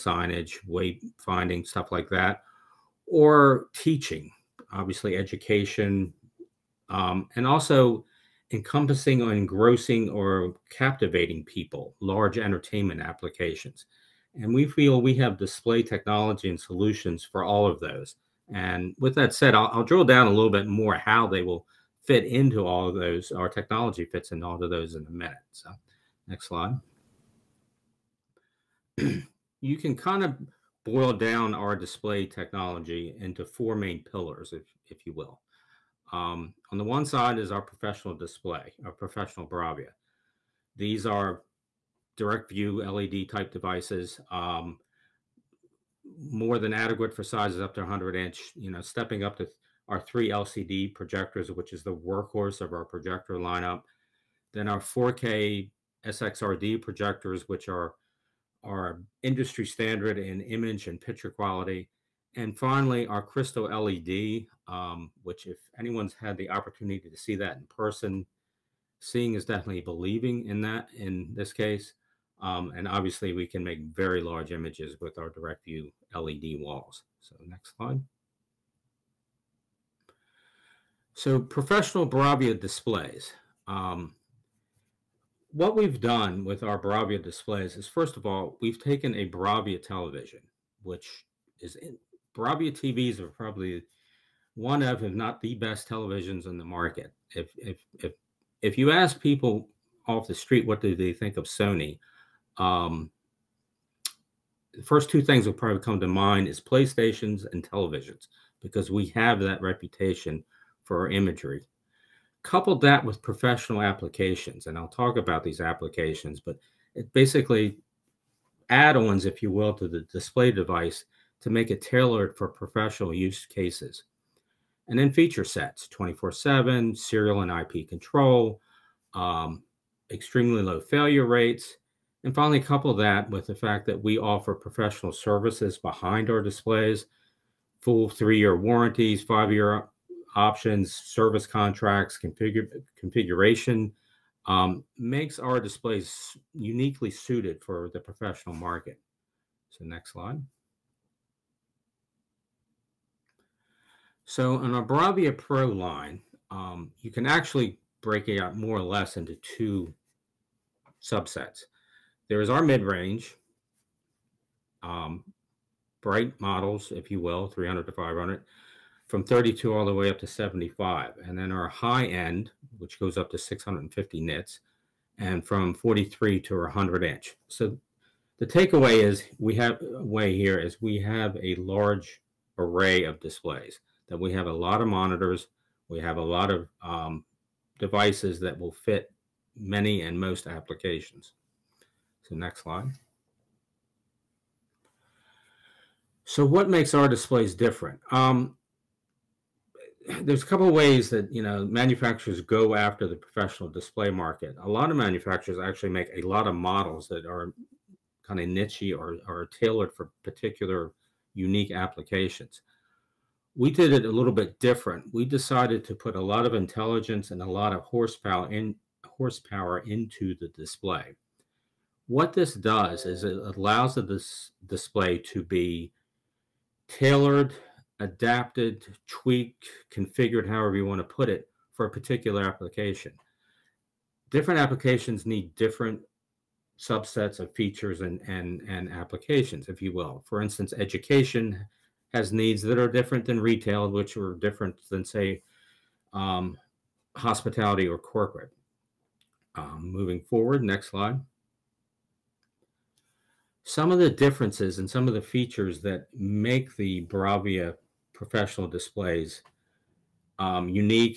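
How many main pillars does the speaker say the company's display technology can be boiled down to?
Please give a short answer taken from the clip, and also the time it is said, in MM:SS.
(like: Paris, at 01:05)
4, at 00:33.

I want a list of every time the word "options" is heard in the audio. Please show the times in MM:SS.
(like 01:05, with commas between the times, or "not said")
02:20.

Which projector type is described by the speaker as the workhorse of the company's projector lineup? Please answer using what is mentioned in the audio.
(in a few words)
3LCD projectors.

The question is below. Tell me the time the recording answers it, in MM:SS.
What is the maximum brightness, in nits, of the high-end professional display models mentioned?
02:53.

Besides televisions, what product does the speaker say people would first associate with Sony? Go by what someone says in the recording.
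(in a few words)
PlayStations.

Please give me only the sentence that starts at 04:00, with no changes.
For instance, education has needs that are different than retail, which are different than, say, um, hospitality or corporate.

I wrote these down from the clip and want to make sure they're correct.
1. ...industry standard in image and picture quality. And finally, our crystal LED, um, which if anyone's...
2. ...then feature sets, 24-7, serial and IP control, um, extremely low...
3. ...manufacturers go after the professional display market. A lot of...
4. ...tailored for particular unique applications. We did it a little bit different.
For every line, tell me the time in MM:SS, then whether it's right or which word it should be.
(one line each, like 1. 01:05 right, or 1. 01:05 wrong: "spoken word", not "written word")
1. 00:59 right
2. 02:04 right
3. 03:21 right
4. 03:29 right.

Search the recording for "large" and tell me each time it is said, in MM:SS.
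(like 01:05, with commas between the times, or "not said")
00:11, 01:14, 03:01.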